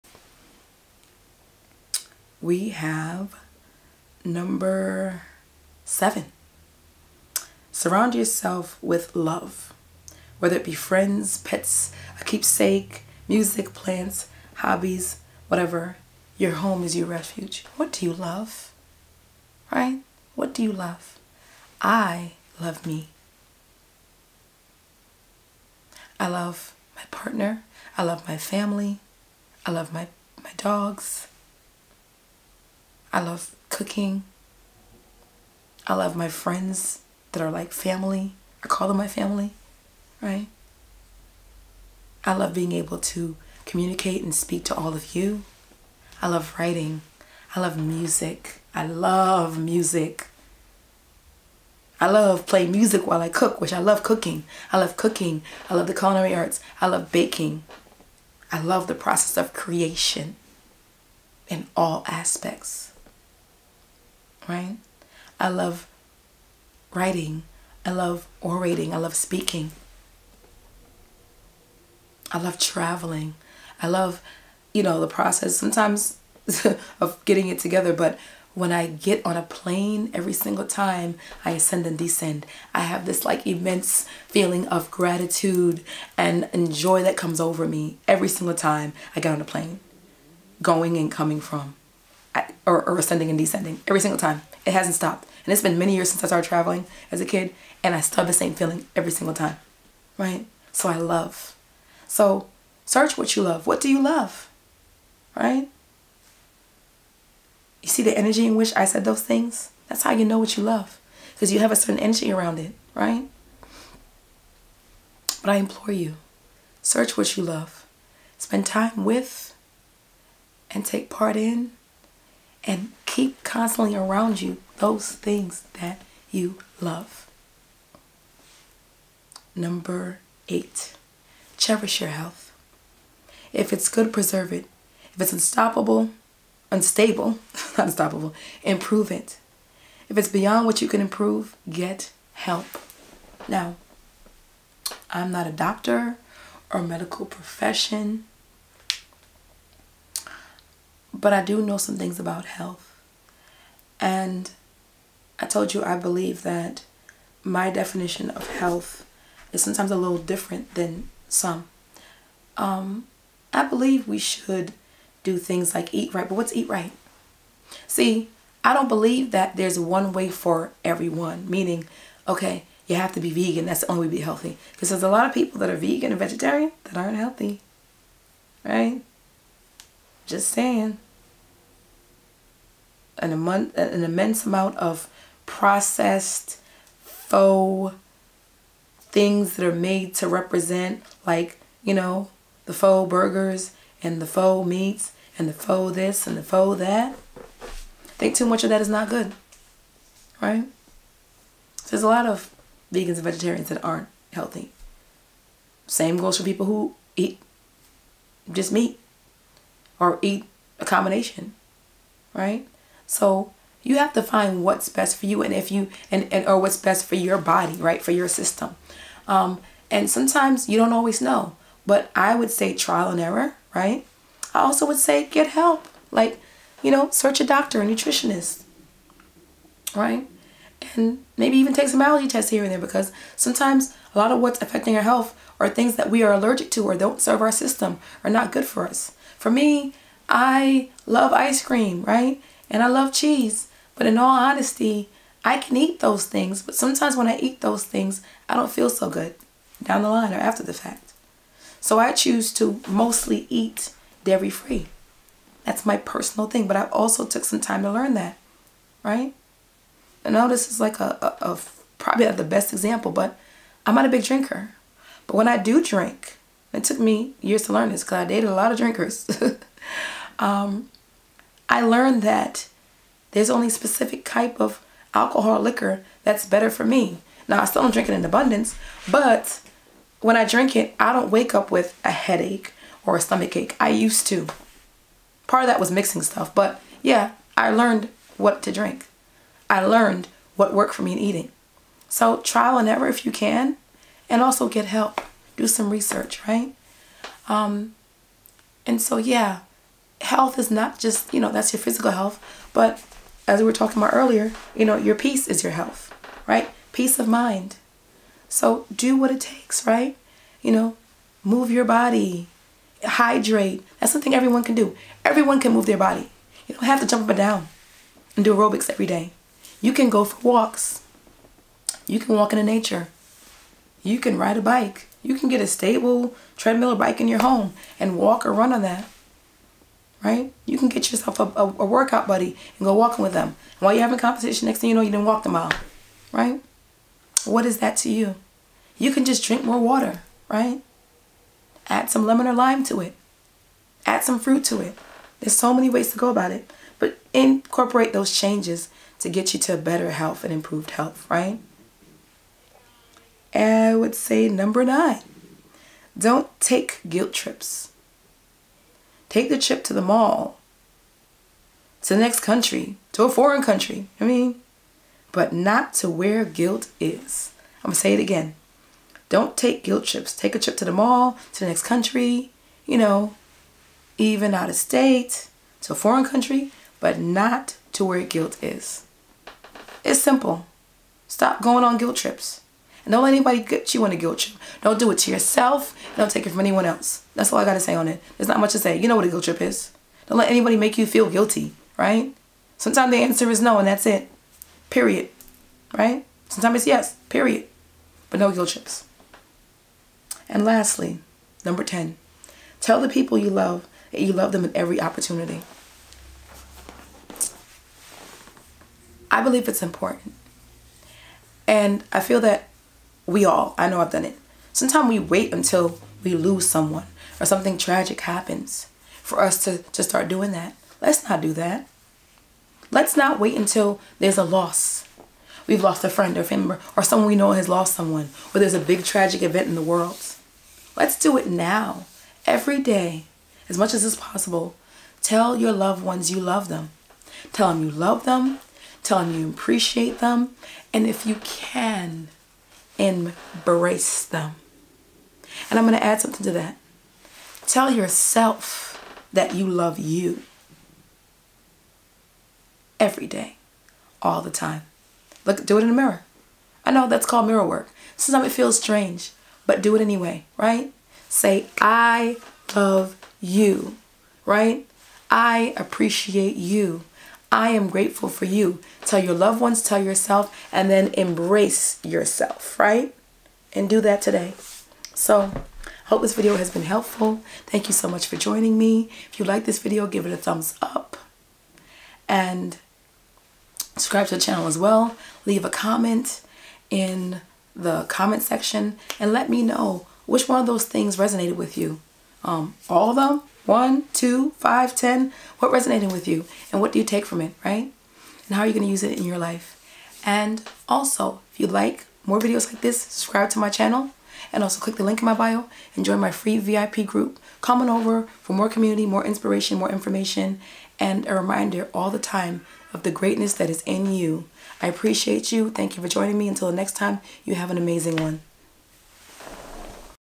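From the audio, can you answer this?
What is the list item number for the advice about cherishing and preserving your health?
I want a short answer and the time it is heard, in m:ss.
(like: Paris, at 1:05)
8, at 2:09.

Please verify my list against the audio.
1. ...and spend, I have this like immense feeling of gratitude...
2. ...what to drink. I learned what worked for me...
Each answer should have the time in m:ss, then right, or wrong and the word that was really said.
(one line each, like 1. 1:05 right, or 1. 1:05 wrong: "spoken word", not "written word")
1. 1:21 wrong: "descend", not "spend"
2. 4:48 right.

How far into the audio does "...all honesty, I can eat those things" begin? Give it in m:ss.
4:04.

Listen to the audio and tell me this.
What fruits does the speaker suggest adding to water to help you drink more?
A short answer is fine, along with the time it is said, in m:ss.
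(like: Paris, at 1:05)
lemon or lime, at 5:42.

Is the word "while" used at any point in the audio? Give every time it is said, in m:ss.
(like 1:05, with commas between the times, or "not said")
0:53, 5:33.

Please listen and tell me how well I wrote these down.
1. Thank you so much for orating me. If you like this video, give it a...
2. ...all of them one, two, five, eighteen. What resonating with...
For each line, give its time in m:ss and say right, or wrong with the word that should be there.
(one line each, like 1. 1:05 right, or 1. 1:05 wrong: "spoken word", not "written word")
1. 7:57 wrong: "joining", not "orating"
2. 8:12 wrong: "ten", not "eighteen".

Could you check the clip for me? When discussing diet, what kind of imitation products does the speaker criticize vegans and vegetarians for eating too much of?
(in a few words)
faux burgers.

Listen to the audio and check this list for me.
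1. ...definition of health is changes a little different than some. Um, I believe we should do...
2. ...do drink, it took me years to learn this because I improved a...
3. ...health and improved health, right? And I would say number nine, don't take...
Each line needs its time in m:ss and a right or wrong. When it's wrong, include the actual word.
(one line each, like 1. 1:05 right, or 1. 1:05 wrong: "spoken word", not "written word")
1. 2:37 wrong: "sometimes", not "changes"
2. 4:25 wrong: "dated", not "improved"
3. 5:50 right.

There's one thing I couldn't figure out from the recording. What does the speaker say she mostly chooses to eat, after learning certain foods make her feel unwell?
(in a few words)
dairy free.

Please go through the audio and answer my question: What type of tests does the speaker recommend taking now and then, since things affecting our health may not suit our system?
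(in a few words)
allergy tests.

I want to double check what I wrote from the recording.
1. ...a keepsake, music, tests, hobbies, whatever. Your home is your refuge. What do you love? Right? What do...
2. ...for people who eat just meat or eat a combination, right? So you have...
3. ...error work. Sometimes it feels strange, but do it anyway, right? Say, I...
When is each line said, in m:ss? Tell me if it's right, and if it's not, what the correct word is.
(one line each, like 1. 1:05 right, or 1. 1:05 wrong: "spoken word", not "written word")
1. 0:12 wrong: "plants", not "tests"
2. 3:26 right
3. 7:37 wrong: "mirror", not "error".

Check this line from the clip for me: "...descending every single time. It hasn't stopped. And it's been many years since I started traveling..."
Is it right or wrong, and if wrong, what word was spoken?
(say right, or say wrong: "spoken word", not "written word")
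right.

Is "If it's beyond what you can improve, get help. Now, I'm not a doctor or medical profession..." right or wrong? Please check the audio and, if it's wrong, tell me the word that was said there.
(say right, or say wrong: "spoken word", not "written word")
right.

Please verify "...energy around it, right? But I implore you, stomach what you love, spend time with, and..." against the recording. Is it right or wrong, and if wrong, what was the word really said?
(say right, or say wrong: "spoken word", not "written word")
wrong: "search", not "stomach".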